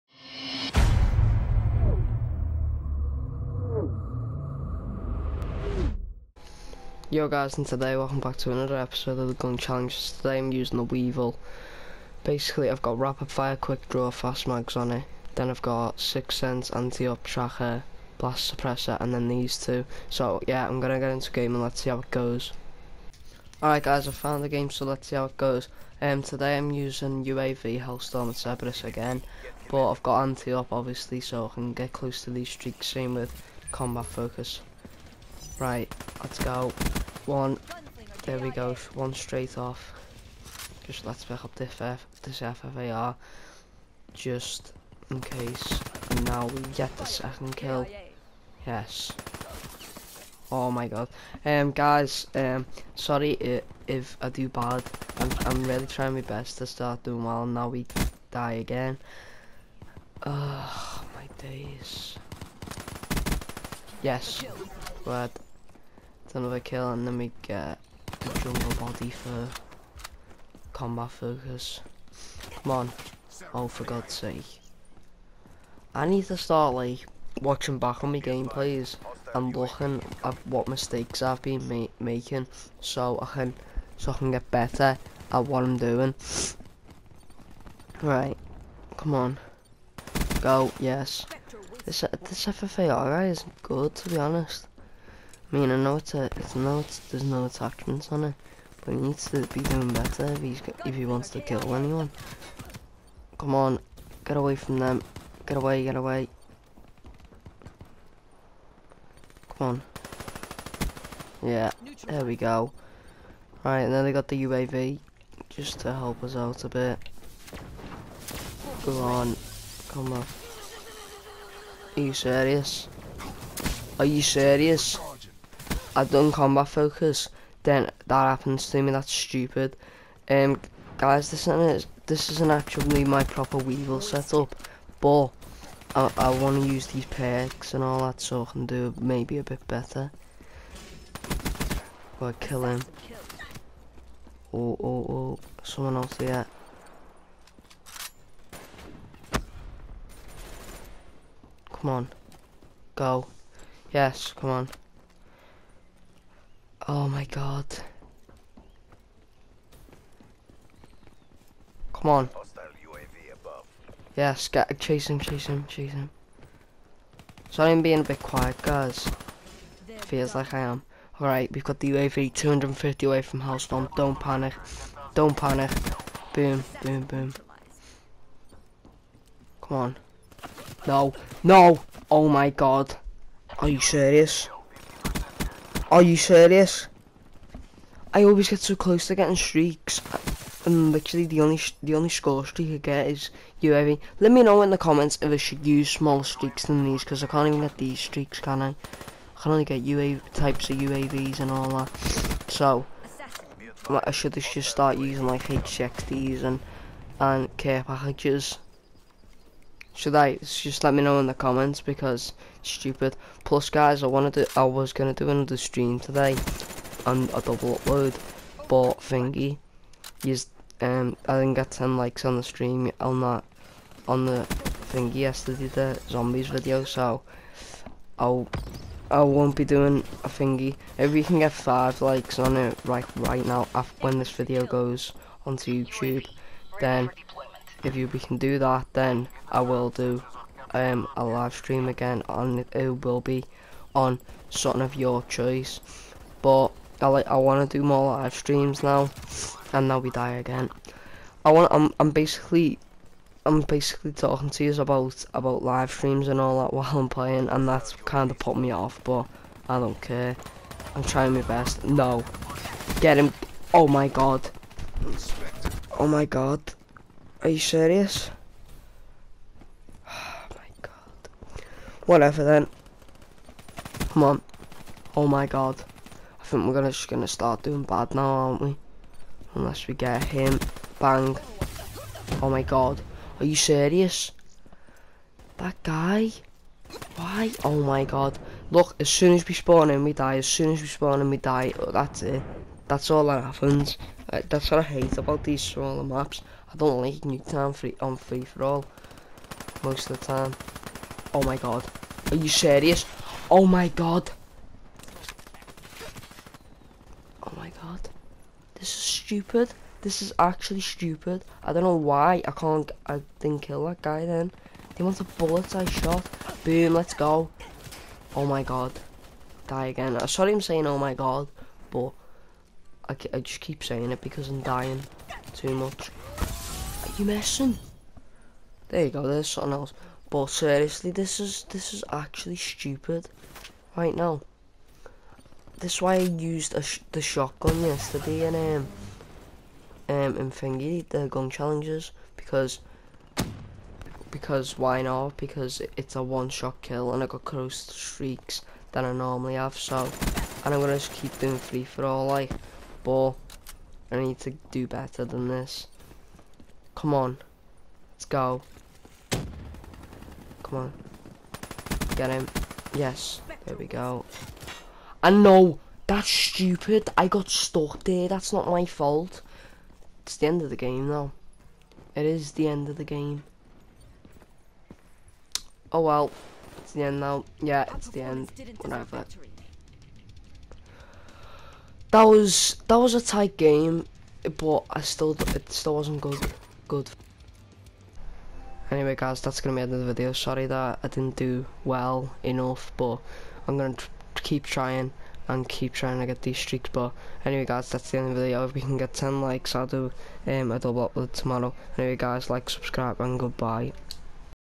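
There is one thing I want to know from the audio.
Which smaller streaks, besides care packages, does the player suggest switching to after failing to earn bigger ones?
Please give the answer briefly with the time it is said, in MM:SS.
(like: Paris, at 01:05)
H60s, at 03:25.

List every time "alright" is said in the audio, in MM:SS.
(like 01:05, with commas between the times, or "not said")
00:23, 01:32, 02:51.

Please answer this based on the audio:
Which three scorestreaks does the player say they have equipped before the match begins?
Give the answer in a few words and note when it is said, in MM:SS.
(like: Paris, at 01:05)
UAV, Hellstorm and Cerberus, at 00:27.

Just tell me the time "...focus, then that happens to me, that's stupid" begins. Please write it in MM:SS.
02:06.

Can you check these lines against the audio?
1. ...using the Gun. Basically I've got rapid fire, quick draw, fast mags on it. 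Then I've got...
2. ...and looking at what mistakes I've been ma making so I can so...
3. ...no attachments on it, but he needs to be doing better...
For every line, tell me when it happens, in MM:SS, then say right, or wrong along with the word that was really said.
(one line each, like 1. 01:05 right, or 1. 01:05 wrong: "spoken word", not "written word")
1. 00:10 wrong: "Weevil", not "Gun"
2. 01:19 right
3. 01:37 right.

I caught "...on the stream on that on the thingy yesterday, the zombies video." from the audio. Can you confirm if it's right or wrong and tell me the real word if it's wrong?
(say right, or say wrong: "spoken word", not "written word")
right.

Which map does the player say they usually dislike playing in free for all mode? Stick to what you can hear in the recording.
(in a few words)
Nuketown.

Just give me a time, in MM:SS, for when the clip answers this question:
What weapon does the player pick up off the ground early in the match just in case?
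00:42.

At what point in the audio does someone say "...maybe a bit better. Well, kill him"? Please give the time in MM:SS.
02:19.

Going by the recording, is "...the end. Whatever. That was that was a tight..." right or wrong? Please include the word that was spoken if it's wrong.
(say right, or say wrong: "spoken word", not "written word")
right.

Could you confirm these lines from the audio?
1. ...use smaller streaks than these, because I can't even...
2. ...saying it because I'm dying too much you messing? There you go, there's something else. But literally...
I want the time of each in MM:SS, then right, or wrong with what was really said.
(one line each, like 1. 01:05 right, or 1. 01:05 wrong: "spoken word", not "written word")
1. 03:15 right
2. 05:23 wrong: "seriously", not "literally".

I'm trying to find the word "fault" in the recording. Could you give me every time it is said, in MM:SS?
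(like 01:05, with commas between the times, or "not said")
06:08.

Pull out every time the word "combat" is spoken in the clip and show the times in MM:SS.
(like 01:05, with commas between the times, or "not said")
00:33, 01:10, 02:06.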